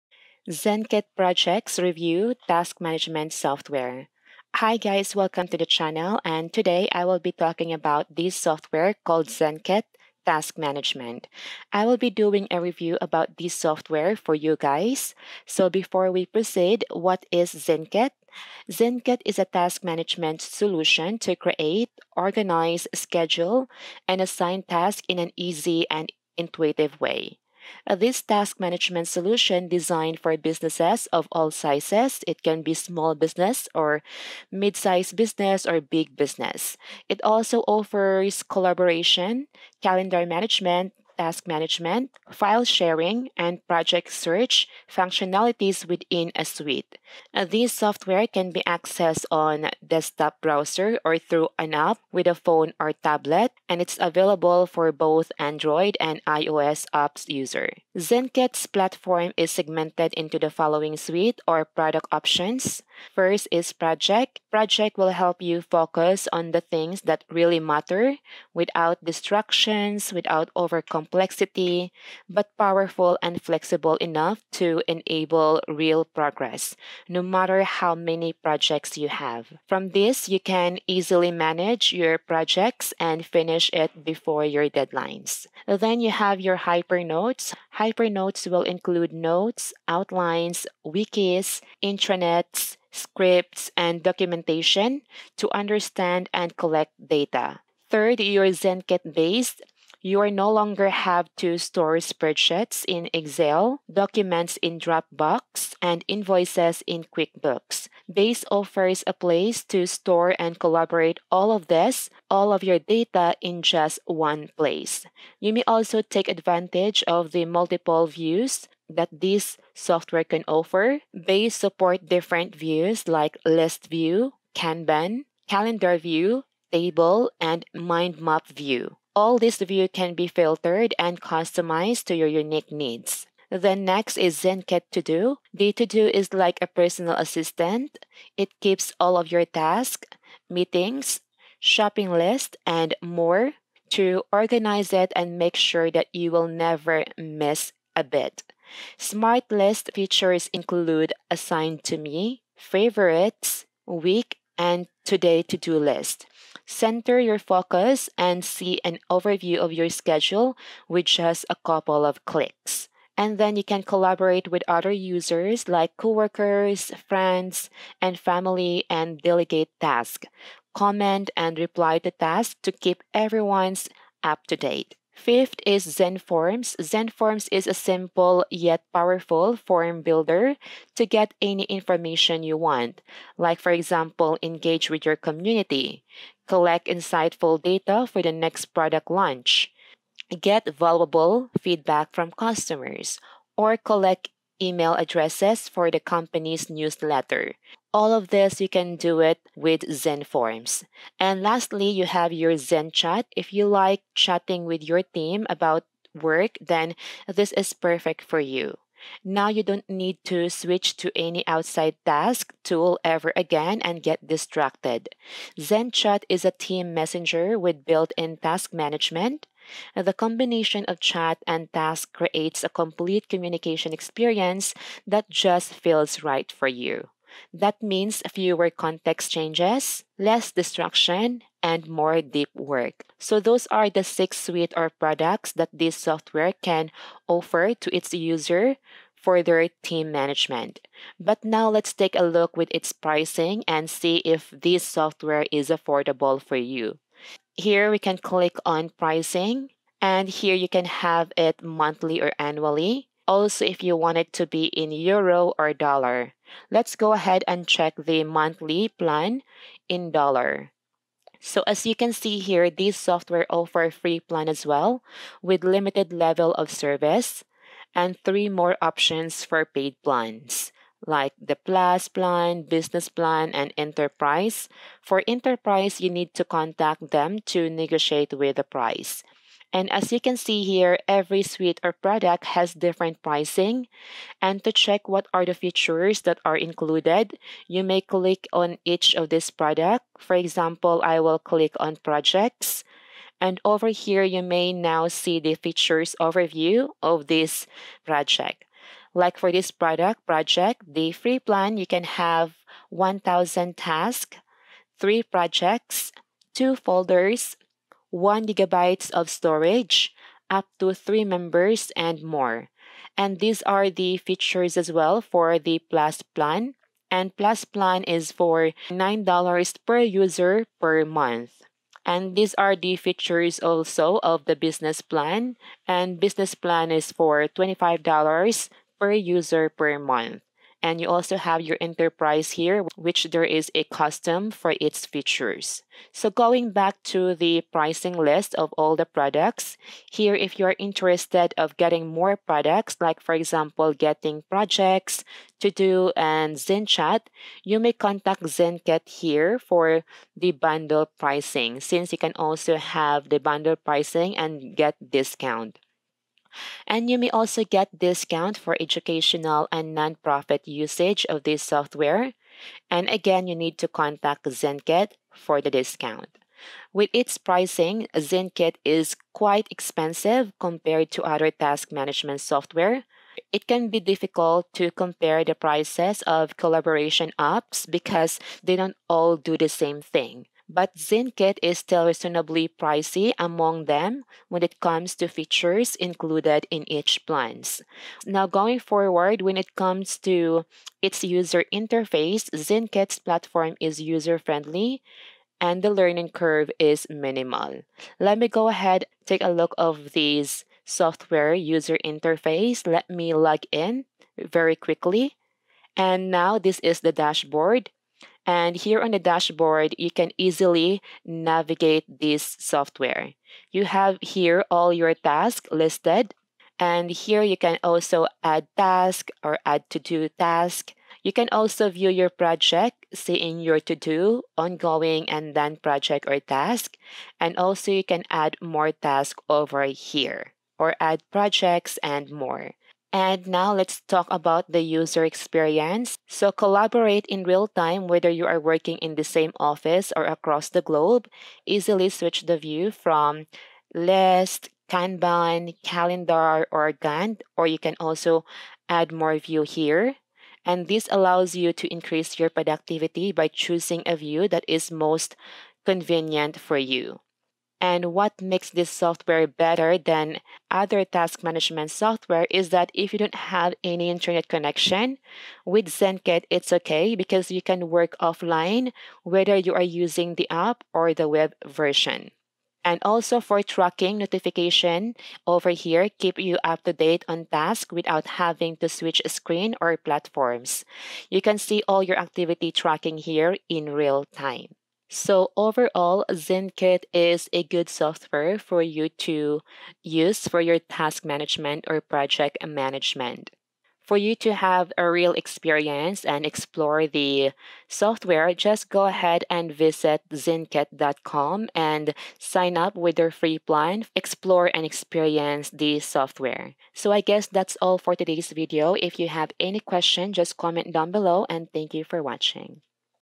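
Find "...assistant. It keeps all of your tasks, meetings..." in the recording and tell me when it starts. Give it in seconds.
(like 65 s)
137 s.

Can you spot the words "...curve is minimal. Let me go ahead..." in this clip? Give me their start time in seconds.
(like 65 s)
396 s.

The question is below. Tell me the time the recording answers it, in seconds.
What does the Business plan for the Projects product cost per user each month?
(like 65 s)
327 s.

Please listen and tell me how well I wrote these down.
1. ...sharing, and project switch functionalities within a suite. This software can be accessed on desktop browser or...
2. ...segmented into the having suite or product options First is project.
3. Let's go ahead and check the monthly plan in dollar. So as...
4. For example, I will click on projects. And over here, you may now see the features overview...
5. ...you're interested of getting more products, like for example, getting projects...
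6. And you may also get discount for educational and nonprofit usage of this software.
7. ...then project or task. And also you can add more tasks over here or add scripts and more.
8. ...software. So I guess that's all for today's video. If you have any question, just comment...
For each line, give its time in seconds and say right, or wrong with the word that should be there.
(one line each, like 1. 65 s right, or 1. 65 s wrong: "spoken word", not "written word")
1. 42 s wrong: "search", not "switch"
2. 59 s wrong: "following", not "having"
3. 256 s right
4. 290 s right
5. 340 s right
6. 356 s right
7. 425 s wrong: "projects", not "scripts"
8. 505 s right.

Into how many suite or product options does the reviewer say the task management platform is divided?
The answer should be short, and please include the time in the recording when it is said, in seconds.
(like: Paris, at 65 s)
6, at 234 s.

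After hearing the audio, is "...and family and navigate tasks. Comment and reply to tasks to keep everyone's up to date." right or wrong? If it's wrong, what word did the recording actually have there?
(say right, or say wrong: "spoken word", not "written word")
wrong: "delegate", not "navigate".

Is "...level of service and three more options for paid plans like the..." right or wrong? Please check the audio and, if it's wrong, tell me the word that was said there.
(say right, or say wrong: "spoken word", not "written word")
right.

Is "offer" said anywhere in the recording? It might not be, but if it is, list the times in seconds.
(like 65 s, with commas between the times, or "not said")
37 s, 108 s, 120 s, 237 s, 263 s.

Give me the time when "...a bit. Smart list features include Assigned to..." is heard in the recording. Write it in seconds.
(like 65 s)
147 s.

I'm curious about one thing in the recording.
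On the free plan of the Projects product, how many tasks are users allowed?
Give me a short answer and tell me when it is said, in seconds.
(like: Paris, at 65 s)
1,000, at 302 s.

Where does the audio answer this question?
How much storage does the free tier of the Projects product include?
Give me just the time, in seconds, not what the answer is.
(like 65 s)
308 s.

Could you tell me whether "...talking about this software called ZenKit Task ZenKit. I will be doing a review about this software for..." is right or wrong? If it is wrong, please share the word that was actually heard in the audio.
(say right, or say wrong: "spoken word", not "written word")
wrong: "Management", not "ZenKit".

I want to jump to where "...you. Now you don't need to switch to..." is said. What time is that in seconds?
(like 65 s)
208 s.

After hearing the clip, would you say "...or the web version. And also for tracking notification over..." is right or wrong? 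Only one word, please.
right.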